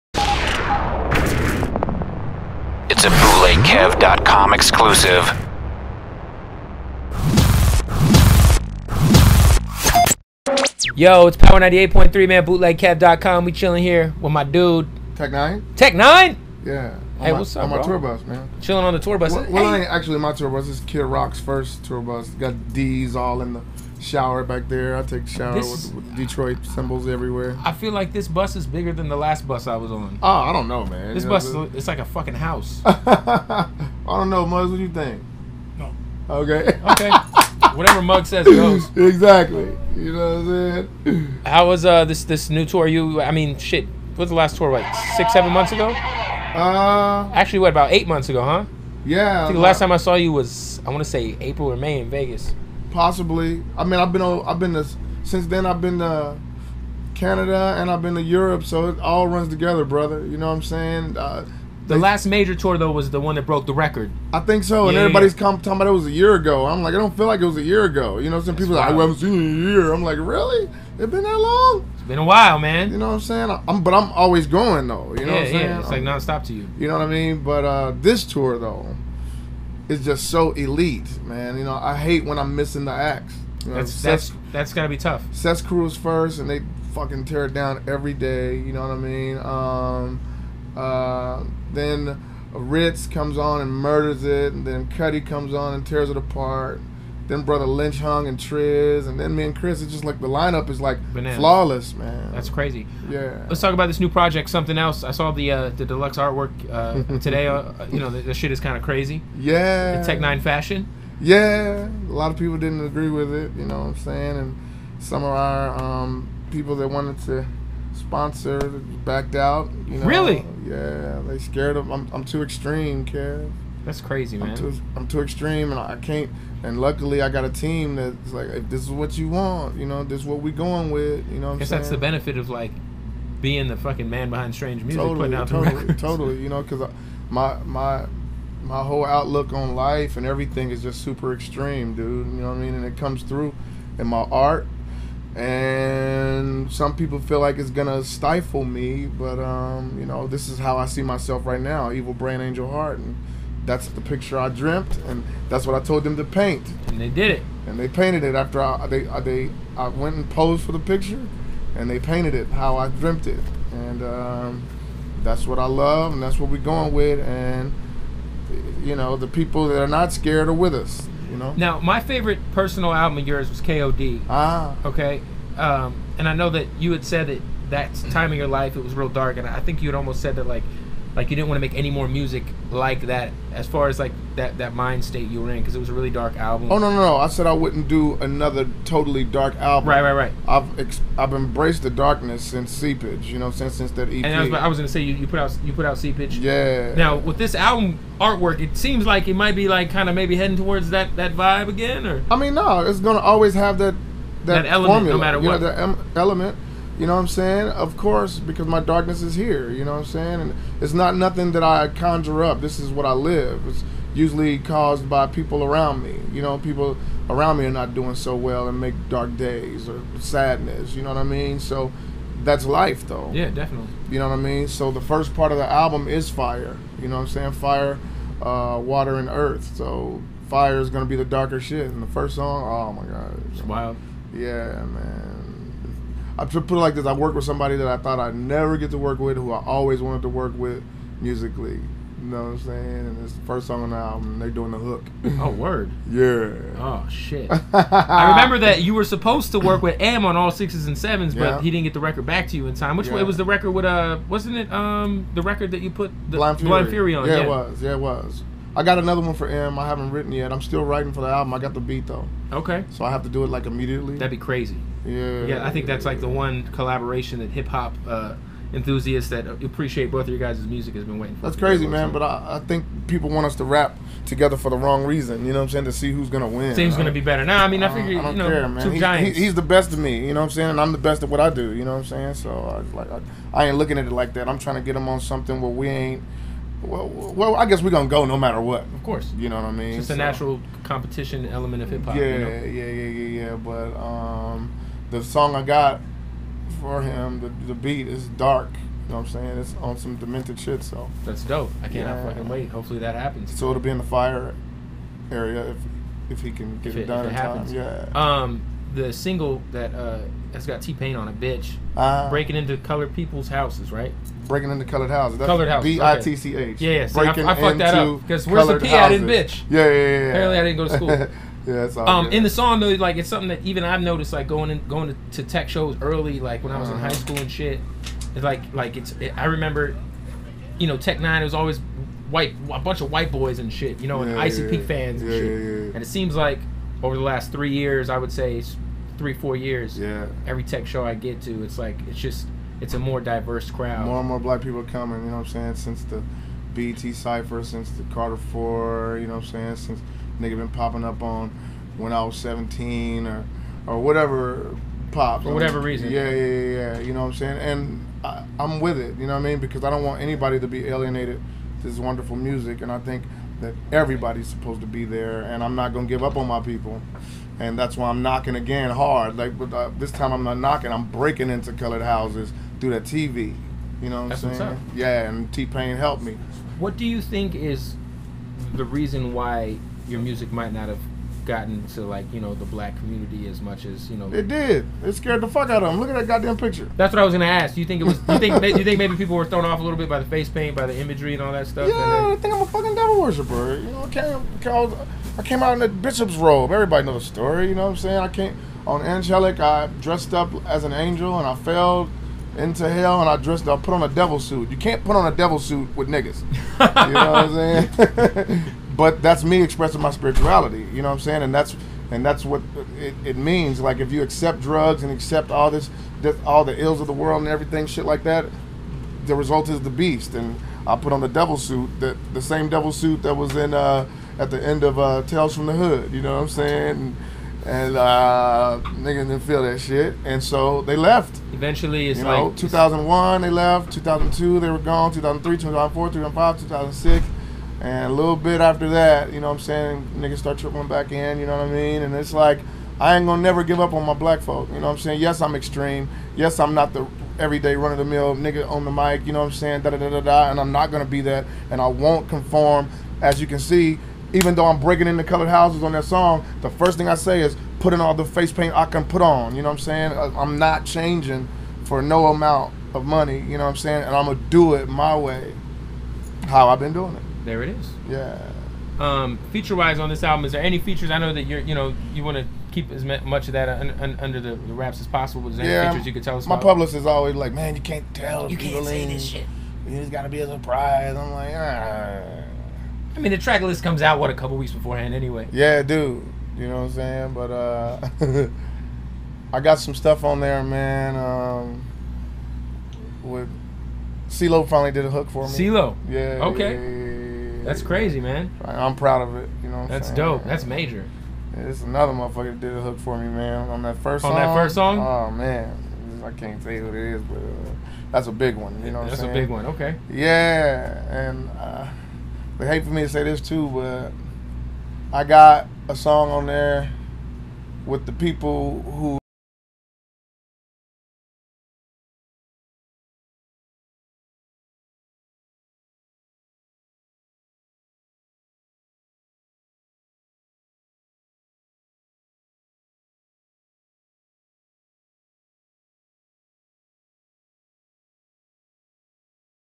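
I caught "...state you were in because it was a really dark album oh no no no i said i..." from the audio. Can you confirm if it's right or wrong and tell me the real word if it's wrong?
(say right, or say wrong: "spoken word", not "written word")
right.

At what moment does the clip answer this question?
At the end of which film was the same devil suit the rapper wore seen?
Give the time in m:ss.
7:05.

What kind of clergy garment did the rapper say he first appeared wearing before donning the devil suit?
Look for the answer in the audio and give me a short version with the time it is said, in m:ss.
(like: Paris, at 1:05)
A bishop's robe, at 6:35.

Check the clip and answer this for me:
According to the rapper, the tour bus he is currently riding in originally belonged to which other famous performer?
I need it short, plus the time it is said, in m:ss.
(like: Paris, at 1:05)
Kid Rock, at 0:20.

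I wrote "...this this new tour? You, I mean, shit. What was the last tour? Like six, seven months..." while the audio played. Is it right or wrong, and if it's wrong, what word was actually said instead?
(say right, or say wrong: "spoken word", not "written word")
right.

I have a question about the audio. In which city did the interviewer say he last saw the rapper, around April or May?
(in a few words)
Vegas.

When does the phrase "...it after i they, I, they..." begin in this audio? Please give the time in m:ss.
2:38.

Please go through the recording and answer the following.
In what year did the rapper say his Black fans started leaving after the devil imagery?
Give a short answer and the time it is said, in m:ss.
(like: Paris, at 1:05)
2001, at 7:12.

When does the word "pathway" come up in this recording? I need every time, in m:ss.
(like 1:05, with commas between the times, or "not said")
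not said.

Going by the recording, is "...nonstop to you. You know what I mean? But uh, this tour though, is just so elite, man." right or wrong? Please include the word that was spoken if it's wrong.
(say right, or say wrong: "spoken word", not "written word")
right.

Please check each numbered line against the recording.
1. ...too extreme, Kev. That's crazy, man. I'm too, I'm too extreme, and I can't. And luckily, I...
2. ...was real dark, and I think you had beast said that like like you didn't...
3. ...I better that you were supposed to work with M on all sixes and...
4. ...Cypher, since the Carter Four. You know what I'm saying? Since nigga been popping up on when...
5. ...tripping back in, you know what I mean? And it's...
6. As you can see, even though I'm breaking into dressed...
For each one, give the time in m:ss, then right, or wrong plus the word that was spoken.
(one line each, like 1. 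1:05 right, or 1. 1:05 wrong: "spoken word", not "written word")
1. 2:02 right
2. 2:58 wrong: "almost", not "beast"
3. 4:07 wrong: "remember", not "better"
4. 5:47 right
5. 7:20 right
6. 7:33 wrong: "colored", not "dressed".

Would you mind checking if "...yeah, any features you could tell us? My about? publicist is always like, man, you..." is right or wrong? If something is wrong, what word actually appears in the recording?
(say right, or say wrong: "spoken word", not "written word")
right.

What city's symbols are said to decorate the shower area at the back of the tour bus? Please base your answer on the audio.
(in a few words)
Detroit.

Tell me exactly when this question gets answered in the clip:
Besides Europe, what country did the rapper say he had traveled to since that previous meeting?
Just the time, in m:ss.
0:57.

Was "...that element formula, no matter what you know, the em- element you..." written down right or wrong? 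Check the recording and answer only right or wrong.
right.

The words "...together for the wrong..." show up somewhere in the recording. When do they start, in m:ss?
4:34.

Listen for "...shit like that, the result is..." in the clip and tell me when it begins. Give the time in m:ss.
6:57.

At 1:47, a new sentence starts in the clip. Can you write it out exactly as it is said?
Uh, you know, the, the shit is kind of crazy.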